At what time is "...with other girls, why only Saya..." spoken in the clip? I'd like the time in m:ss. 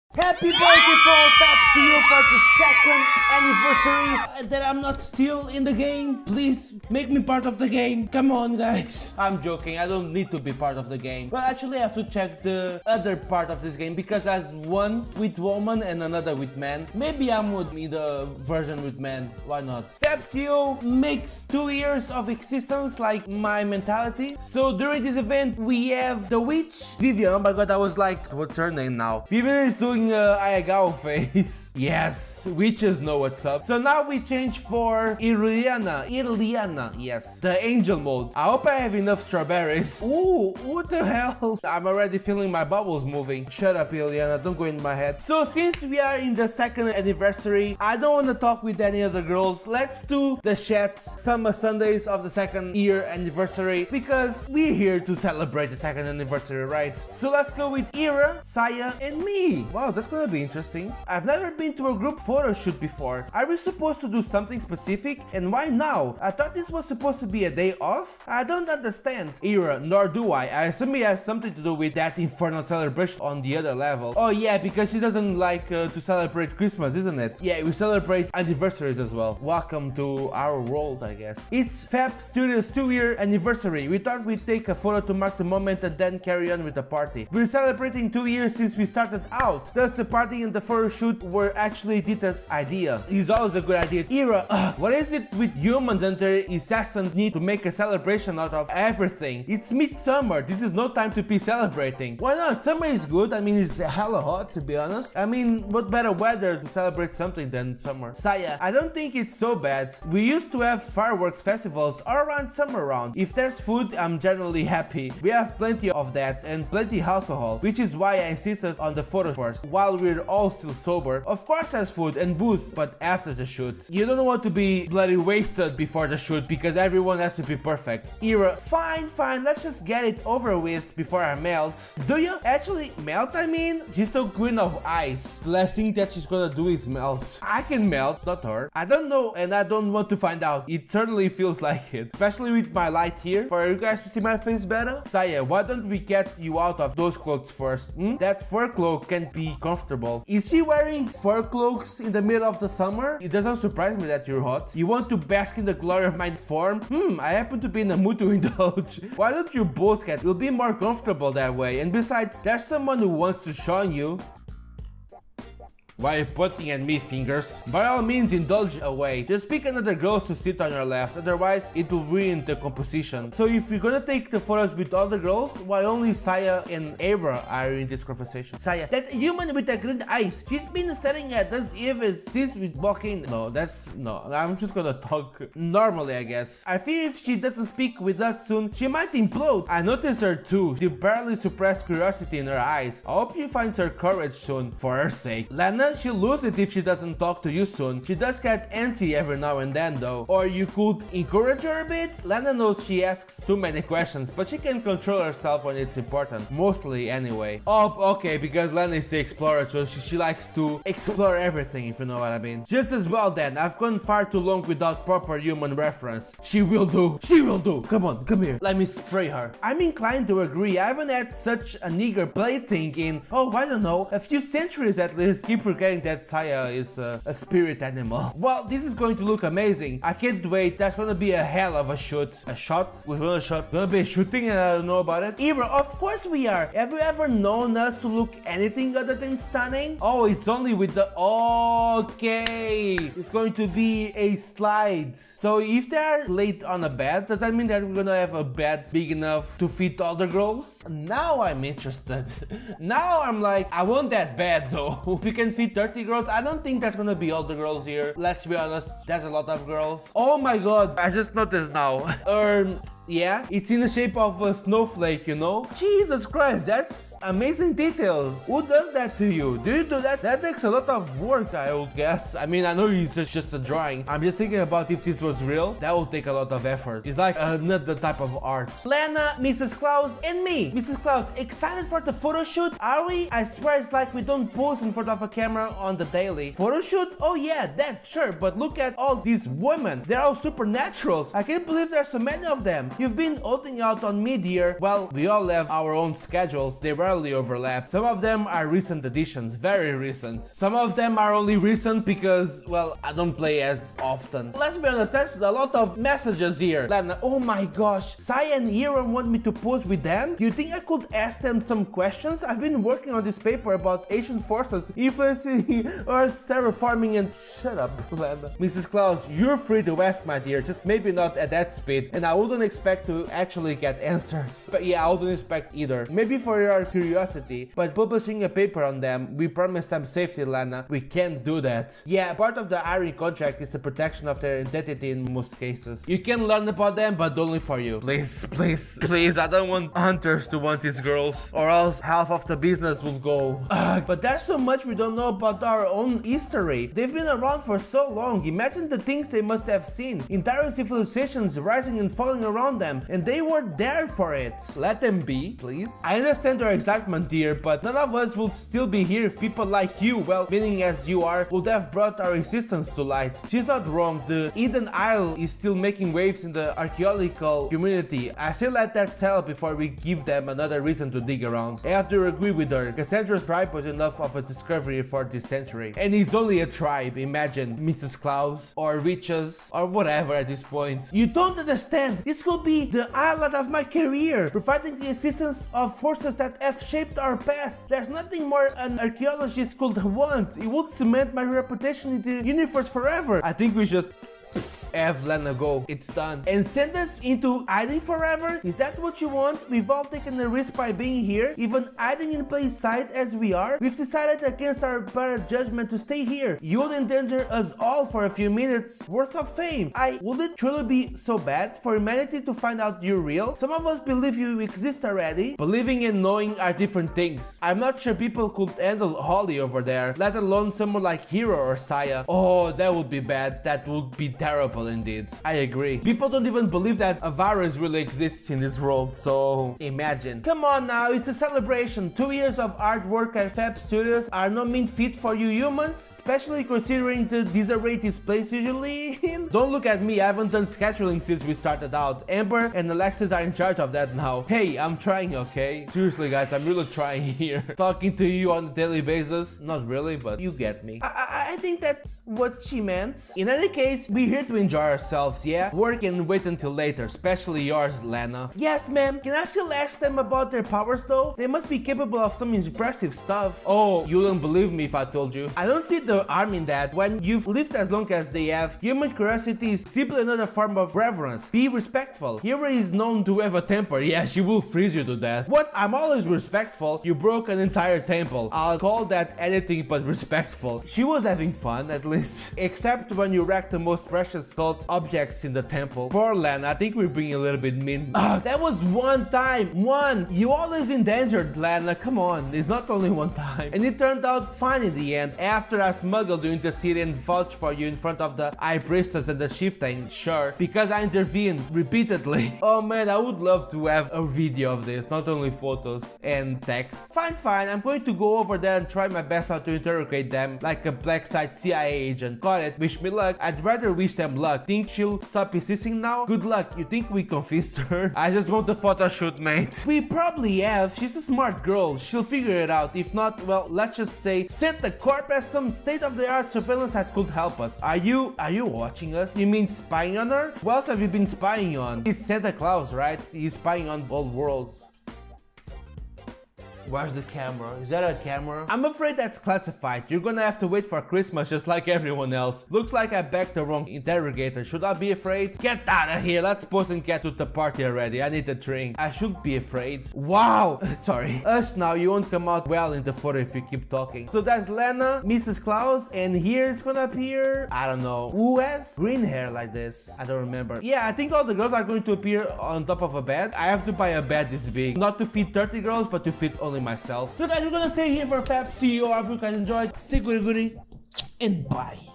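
2:54.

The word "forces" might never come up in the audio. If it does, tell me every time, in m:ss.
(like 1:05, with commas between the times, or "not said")
5:14, 6:25.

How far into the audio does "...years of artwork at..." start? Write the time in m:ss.
7:12.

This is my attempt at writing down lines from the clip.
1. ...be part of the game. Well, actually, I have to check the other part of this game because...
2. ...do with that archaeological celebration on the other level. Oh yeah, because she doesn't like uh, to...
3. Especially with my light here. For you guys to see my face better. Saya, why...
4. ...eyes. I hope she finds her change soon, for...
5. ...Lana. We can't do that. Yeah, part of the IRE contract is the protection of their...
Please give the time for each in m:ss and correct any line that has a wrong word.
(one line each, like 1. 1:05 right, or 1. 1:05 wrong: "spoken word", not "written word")
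1. 0:10 right
2. 1:11 wrong: "infernal", not "archaeological"
3. 2:22 right
4. 3:12 wrong: "courage", not "change"
5. 5:30 right.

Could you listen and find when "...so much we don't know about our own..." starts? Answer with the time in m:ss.
5:44.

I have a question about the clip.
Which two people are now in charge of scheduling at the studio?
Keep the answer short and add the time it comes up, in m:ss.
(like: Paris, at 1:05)
Amber and Alexis, at 7:22.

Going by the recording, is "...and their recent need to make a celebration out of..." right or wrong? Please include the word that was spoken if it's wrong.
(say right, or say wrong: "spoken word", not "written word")
wrong: "incessant", not "recent".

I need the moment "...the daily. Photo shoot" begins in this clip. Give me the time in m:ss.
4:45.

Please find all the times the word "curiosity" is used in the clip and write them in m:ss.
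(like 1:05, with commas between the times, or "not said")
3:11, 5:26, 7:49.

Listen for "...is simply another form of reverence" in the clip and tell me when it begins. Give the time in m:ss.
7:49.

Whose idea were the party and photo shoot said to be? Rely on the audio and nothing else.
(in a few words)
Dita.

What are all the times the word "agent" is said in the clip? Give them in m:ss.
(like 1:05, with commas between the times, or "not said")
8:31.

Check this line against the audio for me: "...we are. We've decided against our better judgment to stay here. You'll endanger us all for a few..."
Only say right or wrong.
right.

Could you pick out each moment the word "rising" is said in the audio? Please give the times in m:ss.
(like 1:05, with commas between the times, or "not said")
5:51.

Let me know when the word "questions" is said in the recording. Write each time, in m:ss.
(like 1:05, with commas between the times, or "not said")
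3:23, 5:11.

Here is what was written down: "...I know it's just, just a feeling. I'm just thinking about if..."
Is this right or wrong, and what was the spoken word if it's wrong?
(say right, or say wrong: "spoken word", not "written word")
wrong: "drawing", not "feeling".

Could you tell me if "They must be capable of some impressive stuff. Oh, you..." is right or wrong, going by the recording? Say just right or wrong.
right.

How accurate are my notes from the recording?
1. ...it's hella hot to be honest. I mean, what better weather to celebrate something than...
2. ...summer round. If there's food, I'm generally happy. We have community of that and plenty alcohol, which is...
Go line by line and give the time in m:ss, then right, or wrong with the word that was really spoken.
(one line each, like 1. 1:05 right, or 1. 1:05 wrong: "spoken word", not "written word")
1. 1:43 right
2. 1:52 wrong: "plenty", not "community".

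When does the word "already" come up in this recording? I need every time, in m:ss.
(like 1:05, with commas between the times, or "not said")
0:41, 6:55, 9:07.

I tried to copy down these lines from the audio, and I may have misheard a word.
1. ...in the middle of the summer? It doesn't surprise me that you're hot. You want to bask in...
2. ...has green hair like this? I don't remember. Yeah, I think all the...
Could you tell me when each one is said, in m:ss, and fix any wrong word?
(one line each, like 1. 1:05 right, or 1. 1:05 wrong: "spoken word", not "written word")
1. 2:31 right
2. 9:18 right.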